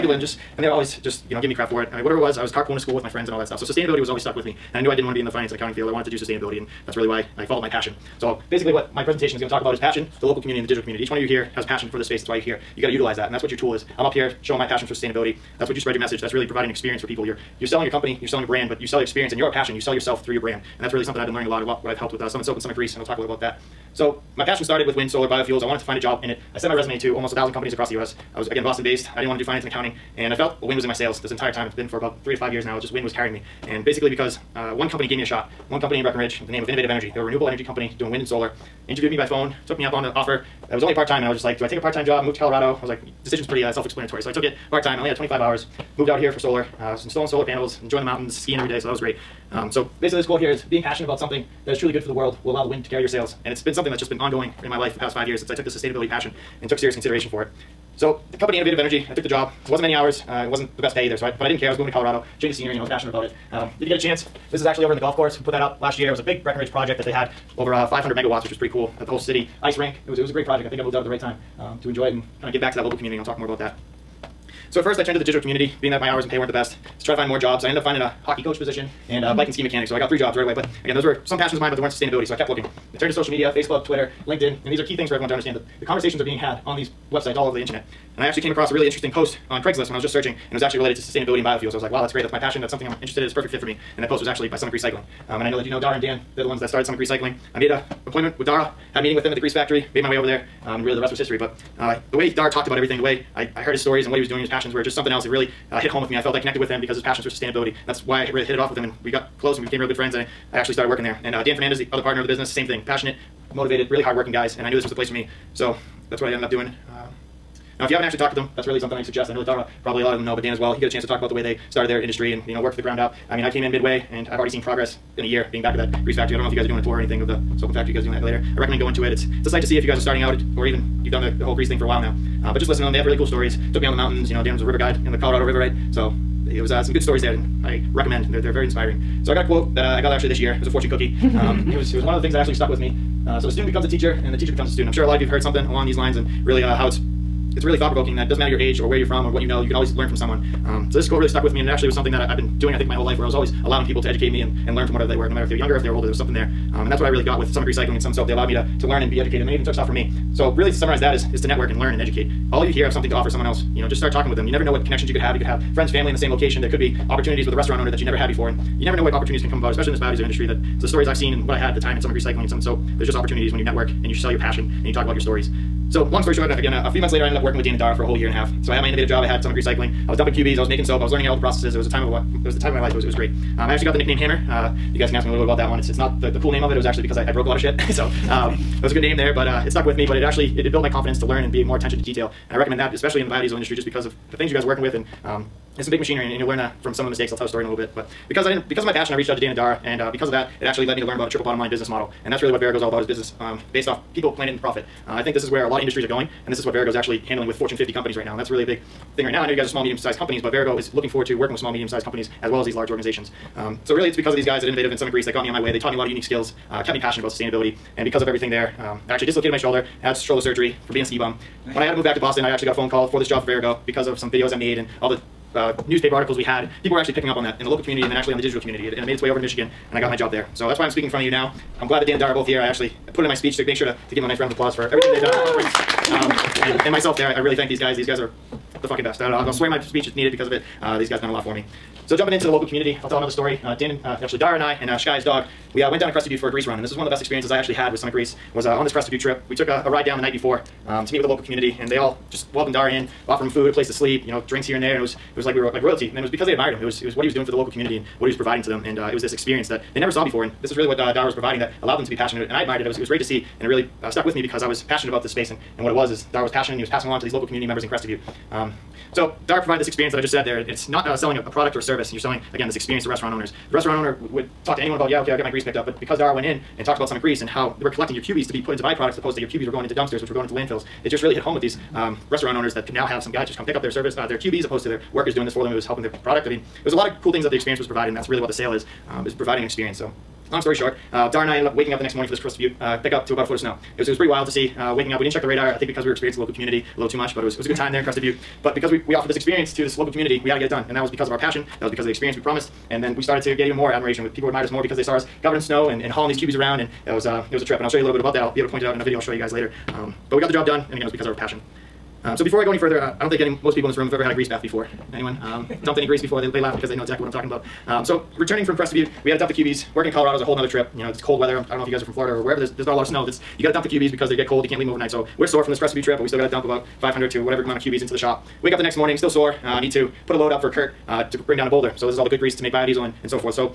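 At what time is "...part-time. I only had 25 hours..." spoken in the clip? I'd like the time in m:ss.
0:44.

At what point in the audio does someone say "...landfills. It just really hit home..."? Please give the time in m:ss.
4:40.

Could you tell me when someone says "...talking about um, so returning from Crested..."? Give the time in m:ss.
5:17.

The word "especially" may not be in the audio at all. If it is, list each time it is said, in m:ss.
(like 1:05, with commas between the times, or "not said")
2:49, 3:12.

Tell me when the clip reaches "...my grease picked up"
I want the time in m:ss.
4:35.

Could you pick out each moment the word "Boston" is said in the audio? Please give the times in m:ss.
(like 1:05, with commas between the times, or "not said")
0:28, 3:42.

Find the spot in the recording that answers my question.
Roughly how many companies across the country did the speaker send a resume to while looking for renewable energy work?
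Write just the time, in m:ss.
0:27.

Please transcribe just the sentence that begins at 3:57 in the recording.
These guys are the fucking best.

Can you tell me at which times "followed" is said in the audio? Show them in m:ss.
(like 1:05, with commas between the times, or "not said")
0:07.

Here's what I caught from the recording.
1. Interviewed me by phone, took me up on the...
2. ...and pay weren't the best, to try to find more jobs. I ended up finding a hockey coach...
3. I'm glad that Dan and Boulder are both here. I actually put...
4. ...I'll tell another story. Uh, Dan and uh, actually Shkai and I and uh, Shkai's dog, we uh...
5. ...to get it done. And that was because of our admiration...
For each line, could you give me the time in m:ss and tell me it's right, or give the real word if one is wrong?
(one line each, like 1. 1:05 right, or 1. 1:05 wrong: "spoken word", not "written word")
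1. 0:38 right
2. 1:16 right
3. 3:51 wrong: "Dara", not "Boulder"
4. 4:03 wrong: "Dara", not "Shkai"
5. 5:00 wrong: "passion", not "admiration".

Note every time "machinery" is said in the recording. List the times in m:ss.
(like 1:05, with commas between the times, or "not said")
3:15.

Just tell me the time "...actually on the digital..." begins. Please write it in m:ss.
3:48.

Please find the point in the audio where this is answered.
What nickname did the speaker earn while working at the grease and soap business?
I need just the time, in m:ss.
3:04.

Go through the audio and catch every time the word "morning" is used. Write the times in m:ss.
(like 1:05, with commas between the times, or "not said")
4:52, 5:28.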